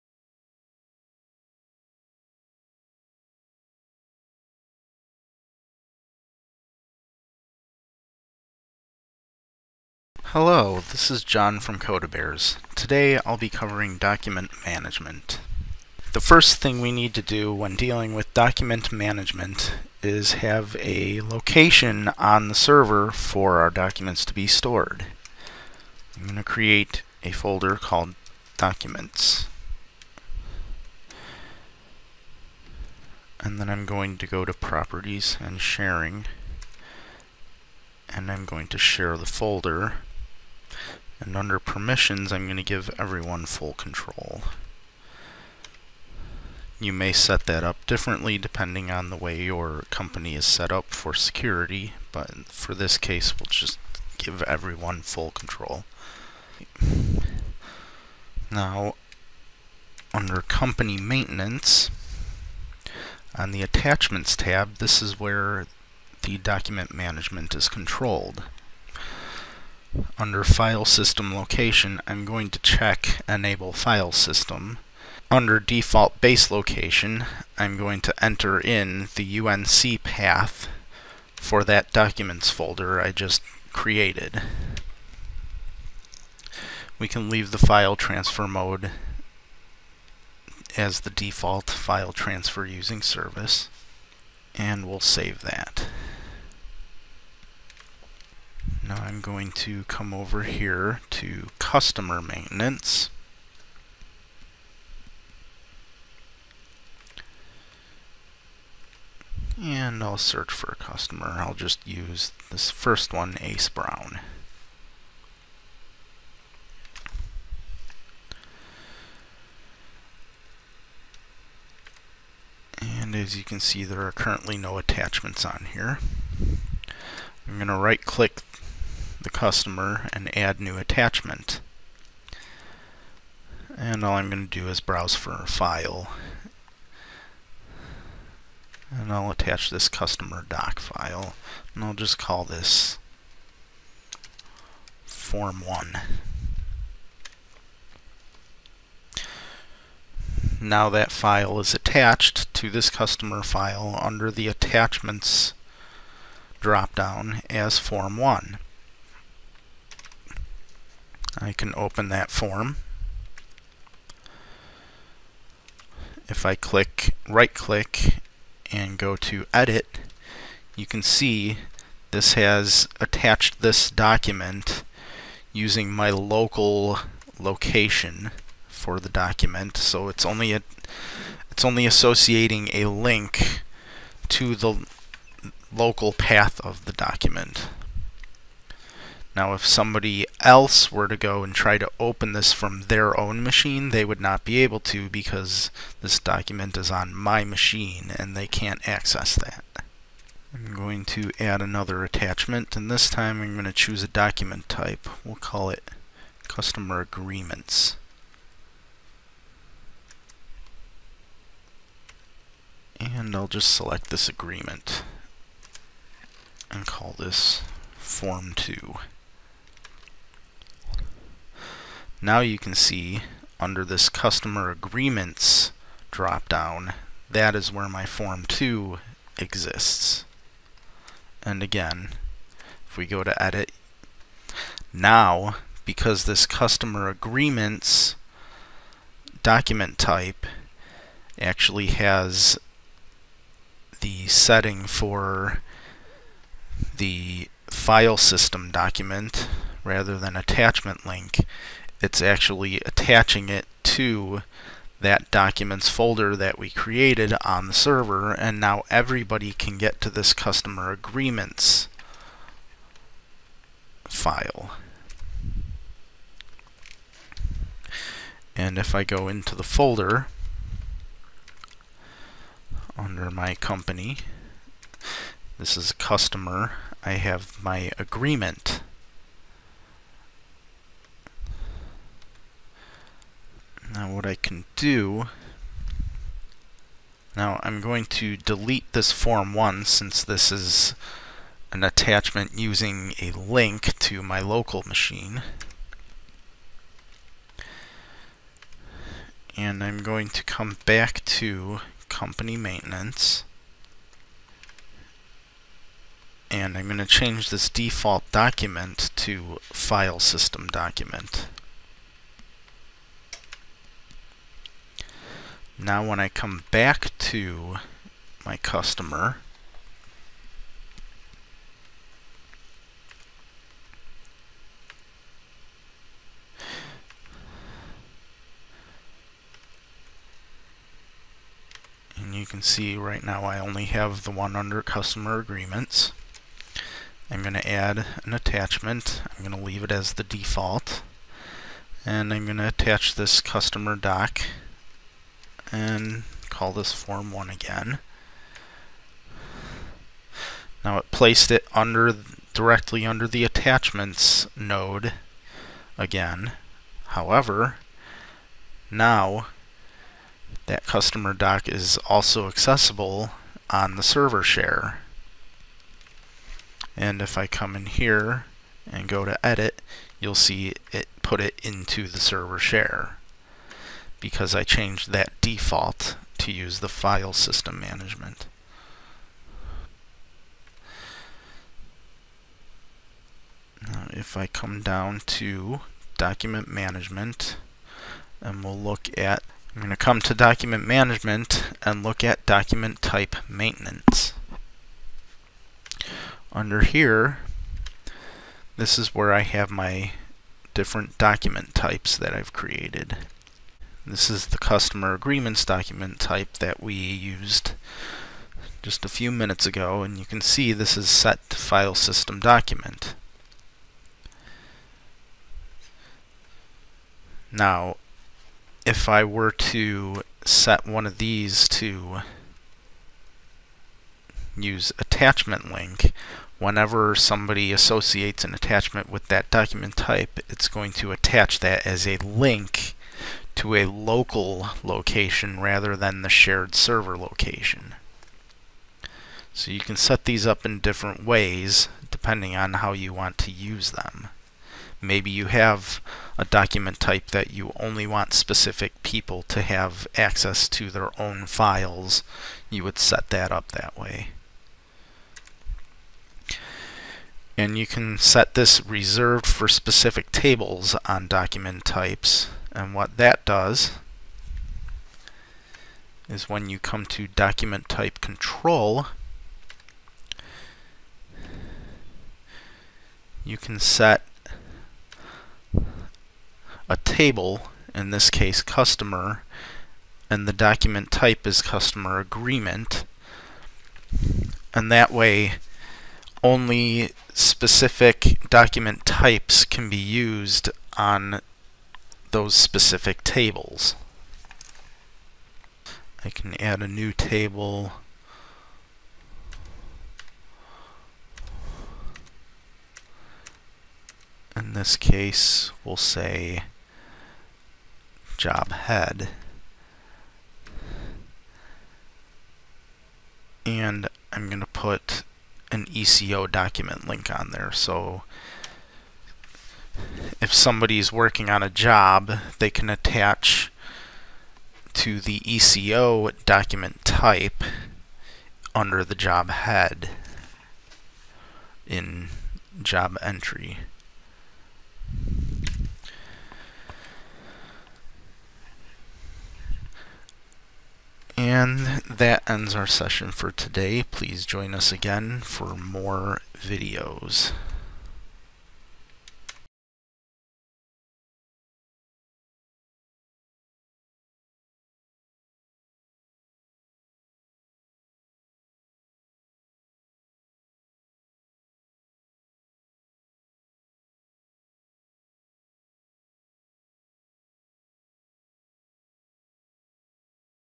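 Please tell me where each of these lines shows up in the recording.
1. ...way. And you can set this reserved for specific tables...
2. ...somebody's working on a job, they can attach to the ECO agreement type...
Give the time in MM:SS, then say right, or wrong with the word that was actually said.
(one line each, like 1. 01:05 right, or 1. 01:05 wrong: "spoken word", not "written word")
1. 07:33 right
2. 08:40 wrong: "document", not "agreement".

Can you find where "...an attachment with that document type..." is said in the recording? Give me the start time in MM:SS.
07:08.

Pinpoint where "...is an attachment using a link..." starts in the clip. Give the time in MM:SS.
04:50.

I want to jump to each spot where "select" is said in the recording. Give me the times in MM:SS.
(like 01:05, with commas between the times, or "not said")
03:33.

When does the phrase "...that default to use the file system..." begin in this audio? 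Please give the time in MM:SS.
06:15.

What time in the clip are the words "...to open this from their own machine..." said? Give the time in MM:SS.
03:11.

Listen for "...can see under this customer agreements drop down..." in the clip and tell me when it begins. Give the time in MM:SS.
03:42.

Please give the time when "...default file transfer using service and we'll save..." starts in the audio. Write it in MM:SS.
01:31.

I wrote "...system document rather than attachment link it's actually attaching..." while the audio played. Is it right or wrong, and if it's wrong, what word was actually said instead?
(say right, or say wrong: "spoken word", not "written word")
right.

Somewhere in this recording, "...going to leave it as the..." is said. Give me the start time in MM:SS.
05:39.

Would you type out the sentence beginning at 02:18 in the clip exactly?
And I'll attach this customer doc file.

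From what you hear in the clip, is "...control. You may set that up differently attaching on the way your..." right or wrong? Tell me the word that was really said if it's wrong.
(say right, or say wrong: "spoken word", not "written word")
wrong: "depending", not "attaching".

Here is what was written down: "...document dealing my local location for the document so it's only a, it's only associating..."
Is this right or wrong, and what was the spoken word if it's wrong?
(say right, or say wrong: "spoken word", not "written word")
wrong: "using", not "dealing".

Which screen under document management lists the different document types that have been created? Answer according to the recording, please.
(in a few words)
Document type maintenance.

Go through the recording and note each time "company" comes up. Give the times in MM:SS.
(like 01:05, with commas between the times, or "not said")
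00:49, 01:00, 04:33, 05:02.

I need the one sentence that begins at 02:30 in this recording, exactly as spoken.
Now that file is attached to this customer file under the Attachments dropdown as Form 1.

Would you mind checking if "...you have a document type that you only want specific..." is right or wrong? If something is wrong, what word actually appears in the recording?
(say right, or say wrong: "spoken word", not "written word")
right.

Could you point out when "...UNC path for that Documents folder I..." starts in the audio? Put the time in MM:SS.
01:19.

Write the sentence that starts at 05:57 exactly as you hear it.
However, now that customer doc is also accessible on the server share.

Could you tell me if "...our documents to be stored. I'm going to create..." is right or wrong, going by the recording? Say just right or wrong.
right.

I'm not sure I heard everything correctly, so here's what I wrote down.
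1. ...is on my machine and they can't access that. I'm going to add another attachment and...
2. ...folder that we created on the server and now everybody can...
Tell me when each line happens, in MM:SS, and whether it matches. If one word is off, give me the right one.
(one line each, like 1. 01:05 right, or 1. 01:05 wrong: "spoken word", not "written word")
1. 03:16 right
2. 04:15 right.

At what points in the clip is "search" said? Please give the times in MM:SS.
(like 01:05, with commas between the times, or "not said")
01:50.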